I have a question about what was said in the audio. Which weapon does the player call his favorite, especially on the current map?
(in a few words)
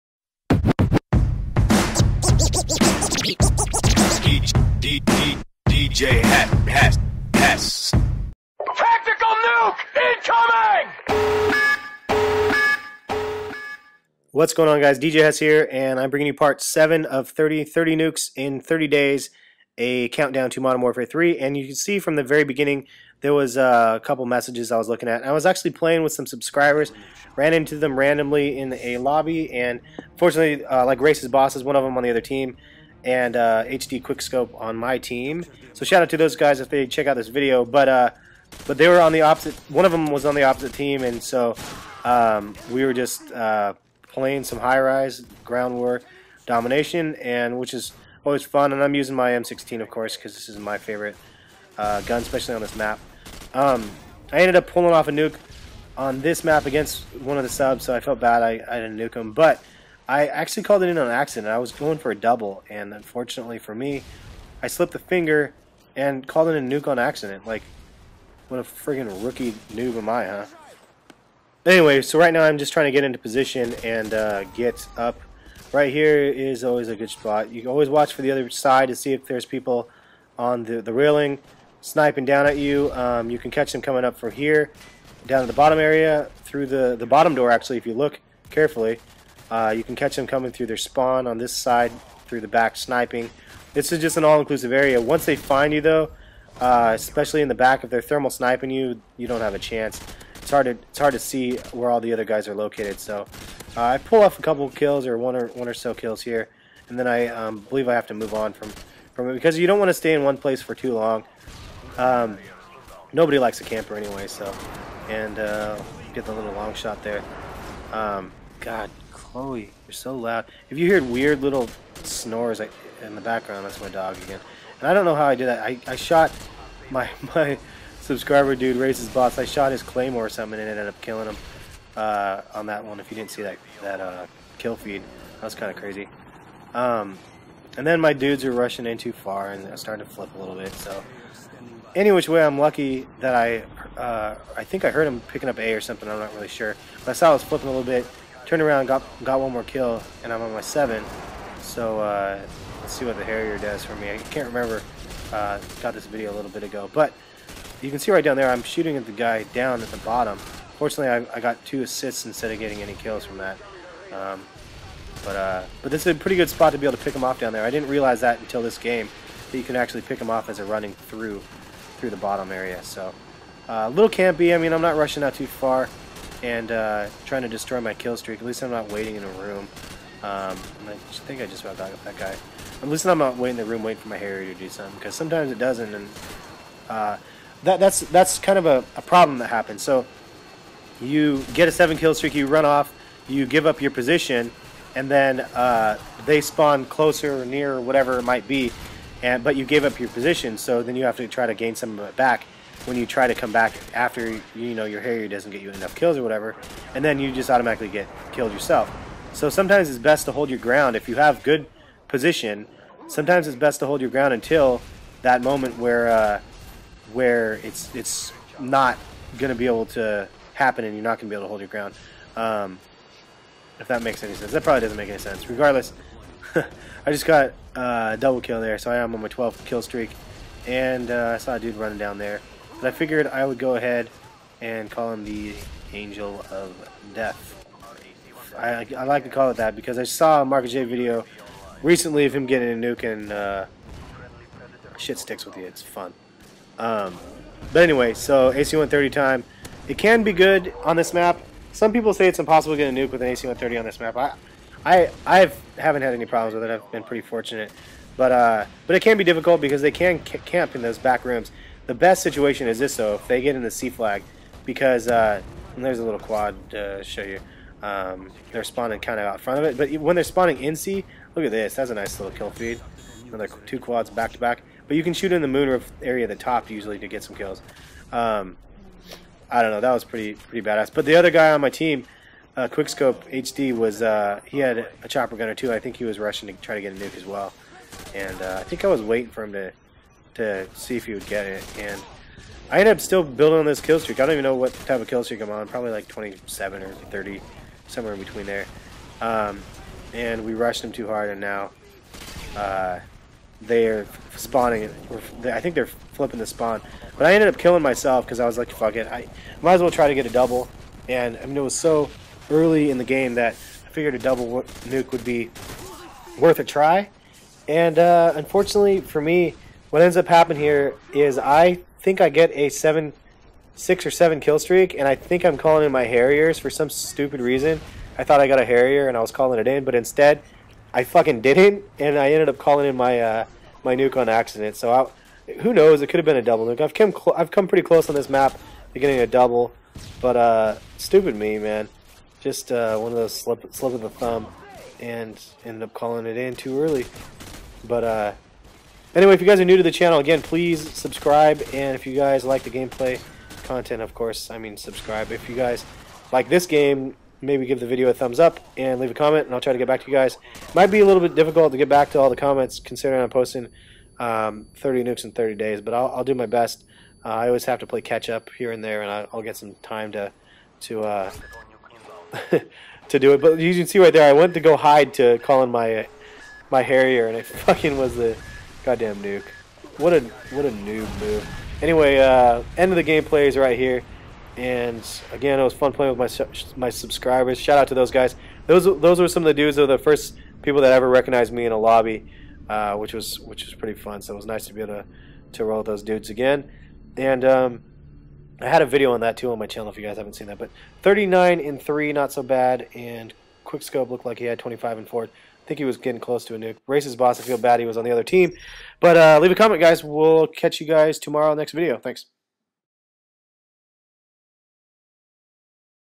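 M16.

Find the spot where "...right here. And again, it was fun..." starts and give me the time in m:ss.
6:23.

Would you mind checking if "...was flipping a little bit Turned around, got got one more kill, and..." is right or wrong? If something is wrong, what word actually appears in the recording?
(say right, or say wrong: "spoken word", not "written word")
right.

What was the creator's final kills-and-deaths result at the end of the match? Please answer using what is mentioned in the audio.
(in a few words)
39 and 3.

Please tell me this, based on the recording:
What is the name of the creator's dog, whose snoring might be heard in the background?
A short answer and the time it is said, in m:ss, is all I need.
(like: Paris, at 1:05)
Chloe, at 1:59.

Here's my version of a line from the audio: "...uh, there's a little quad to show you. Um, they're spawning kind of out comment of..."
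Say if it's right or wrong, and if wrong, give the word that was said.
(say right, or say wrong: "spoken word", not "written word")
wrong: "front", not "comment".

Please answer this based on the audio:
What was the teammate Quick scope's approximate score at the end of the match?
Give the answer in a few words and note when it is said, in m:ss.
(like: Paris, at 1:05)
25 and 4, at 6:44.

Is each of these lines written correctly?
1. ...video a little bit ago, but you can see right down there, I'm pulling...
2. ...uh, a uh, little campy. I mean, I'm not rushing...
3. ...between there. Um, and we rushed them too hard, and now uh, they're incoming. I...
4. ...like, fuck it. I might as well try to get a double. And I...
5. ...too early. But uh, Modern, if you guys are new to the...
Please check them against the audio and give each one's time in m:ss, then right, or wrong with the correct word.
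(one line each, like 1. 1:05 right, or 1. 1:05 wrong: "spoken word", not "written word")
1. 2:36 wrong: "shooting", not "pulling"
2. 2:53 right
3. 4:58 wrong: "spawning", not "incoming"
4. 5:08 right
5. 5:46 wrong: "Anyway", not "Modern".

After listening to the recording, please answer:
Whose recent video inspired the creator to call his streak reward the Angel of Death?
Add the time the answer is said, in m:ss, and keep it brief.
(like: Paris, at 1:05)
Marcus J, at 4:00.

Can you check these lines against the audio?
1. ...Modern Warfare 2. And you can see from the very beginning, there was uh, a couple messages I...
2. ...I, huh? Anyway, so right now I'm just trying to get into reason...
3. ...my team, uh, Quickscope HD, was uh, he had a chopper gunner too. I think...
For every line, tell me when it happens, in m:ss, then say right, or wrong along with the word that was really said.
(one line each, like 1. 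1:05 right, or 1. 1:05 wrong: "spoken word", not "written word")
1. 0:20 wrong: "3", not "2"
2. 1:10 wrong: "position", not "reason"
3. 4:41 right.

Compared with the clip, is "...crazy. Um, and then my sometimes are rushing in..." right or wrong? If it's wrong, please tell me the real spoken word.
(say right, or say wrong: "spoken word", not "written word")
wrong: "dudes", not "sometimes".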